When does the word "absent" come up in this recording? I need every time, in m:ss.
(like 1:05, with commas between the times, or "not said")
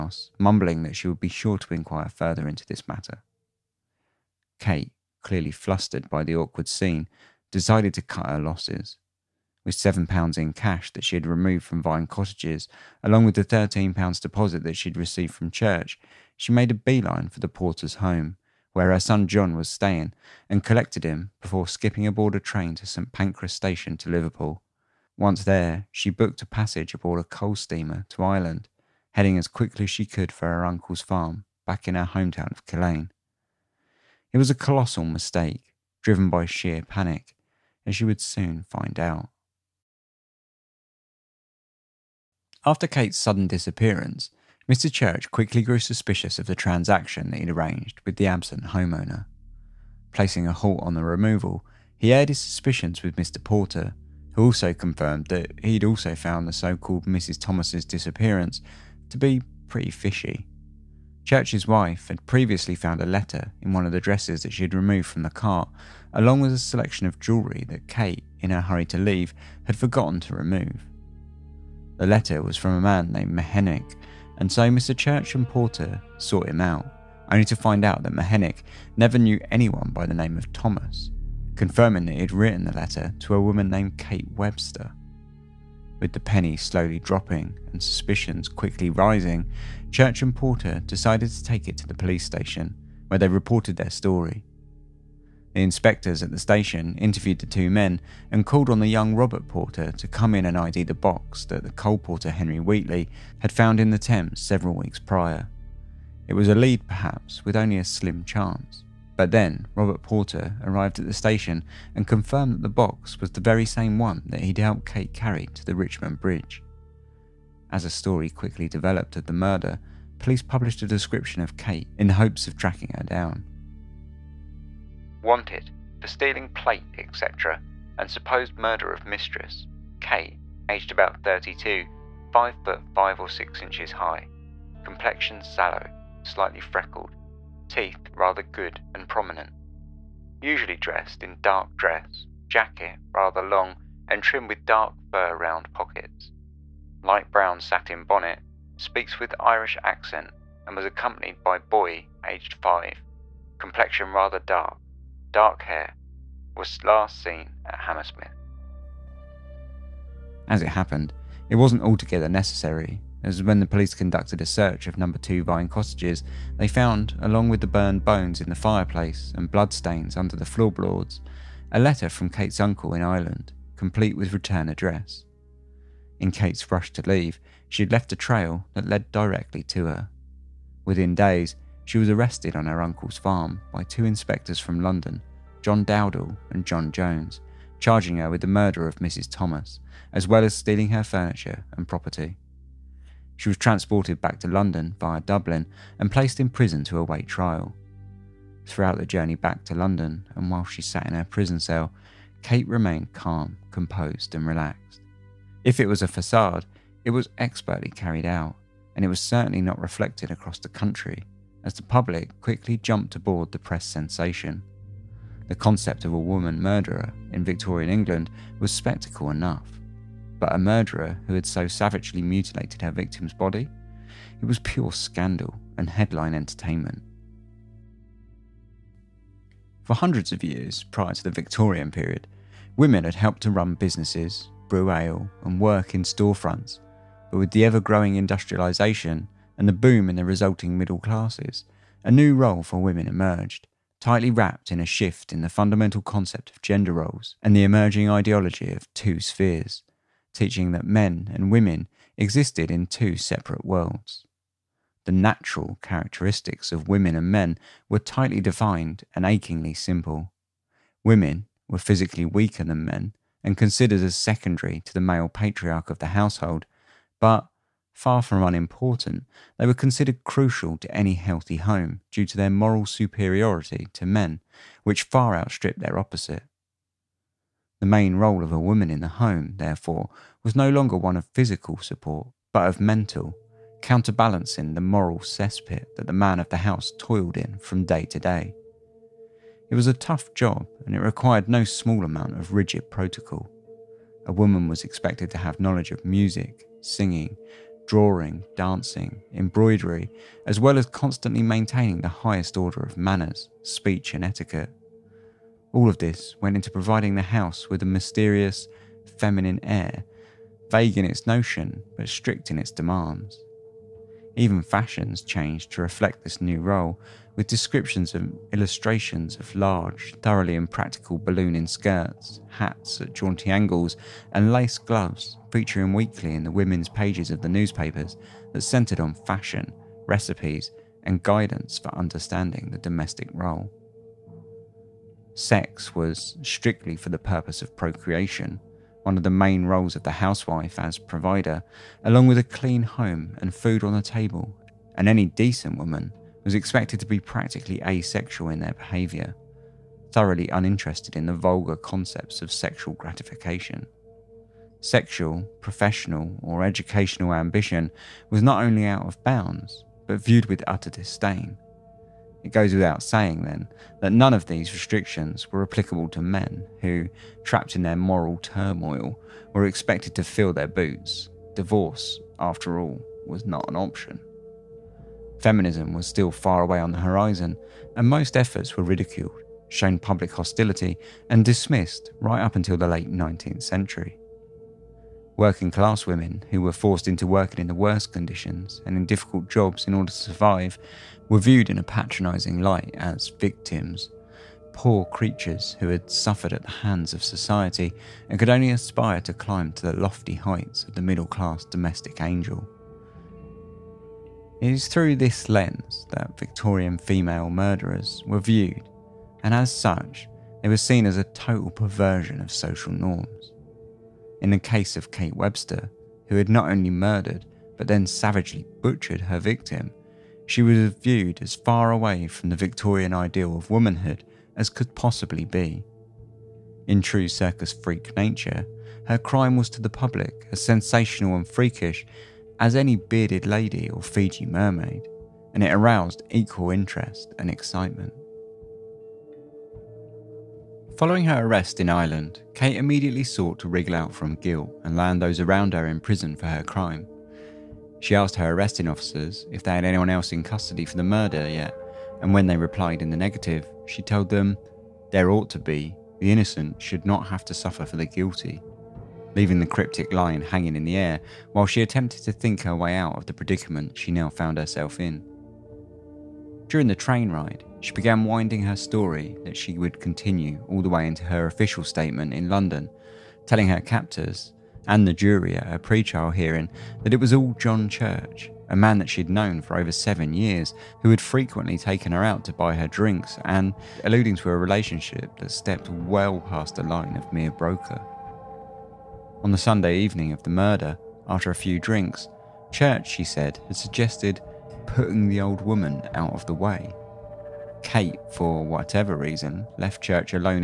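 0:48.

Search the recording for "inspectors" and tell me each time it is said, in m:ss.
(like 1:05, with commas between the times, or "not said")
1:35, 3:04.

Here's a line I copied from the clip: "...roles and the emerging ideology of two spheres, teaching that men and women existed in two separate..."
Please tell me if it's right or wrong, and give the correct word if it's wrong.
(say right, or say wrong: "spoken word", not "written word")
right.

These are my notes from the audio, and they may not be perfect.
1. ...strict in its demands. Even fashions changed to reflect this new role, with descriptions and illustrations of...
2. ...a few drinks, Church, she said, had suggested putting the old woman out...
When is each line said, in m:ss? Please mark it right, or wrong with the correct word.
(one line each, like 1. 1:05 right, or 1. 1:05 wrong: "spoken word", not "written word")
1. 5:12 right
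2. 8:11 right.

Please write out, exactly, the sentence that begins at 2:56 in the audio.
In Kate's rush to leave, she had left a trail that led directly to her.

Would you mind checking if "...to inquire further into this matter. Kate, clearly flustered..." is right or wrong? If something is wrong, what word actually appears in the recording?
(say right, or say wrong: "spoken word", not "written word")
right.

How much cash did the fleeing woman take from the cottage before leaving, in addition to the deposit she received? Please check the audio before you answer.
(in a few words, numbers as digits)
£7.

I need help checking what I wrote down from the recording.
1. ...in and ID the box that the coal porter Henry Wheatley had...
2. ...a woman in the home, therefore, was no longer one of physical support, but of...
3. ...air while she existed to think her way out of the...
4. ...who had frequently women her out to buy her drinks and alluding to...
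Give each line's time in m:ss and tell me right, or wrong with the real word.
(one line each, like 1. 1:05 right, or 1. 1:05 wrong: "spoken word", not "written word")
1. 1:40 right
2. 4:38 right
3. 7:40 wrong: "attempted", not "existed"
4. 8:01 wrong: "taken", not "women".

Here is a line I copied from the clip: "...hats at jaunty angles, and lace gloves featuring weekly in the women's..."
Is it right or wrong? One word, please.
right.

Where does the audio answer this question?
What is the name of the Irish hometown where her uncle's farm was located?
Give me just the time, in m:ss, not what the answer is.
0:32.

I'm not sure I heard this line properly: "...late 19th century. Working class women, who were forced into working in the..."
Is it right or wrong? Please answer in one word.
right.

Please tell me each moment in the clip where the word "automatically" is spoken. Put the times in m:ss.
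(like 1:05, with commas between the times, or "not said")
not said.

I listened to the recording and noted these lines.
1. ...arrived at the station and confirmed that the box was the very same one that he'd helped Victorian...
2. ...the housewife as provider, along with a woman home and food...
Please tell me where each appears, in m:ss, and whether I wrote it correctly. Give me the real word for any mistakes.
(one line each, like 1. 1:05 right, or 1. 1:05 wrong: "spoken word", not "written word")
1. 1:50 wrong: "Kate", not "Victorian"
2. 5:40 wrong: "clean", not "woman".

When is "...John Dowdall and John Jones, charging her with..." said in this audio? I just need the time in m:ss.
3:05.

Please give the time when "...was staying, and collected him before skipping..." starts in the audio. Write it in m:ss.
0:19.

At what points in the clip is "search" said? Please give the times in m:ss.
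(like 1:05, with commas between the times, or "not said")
2:44.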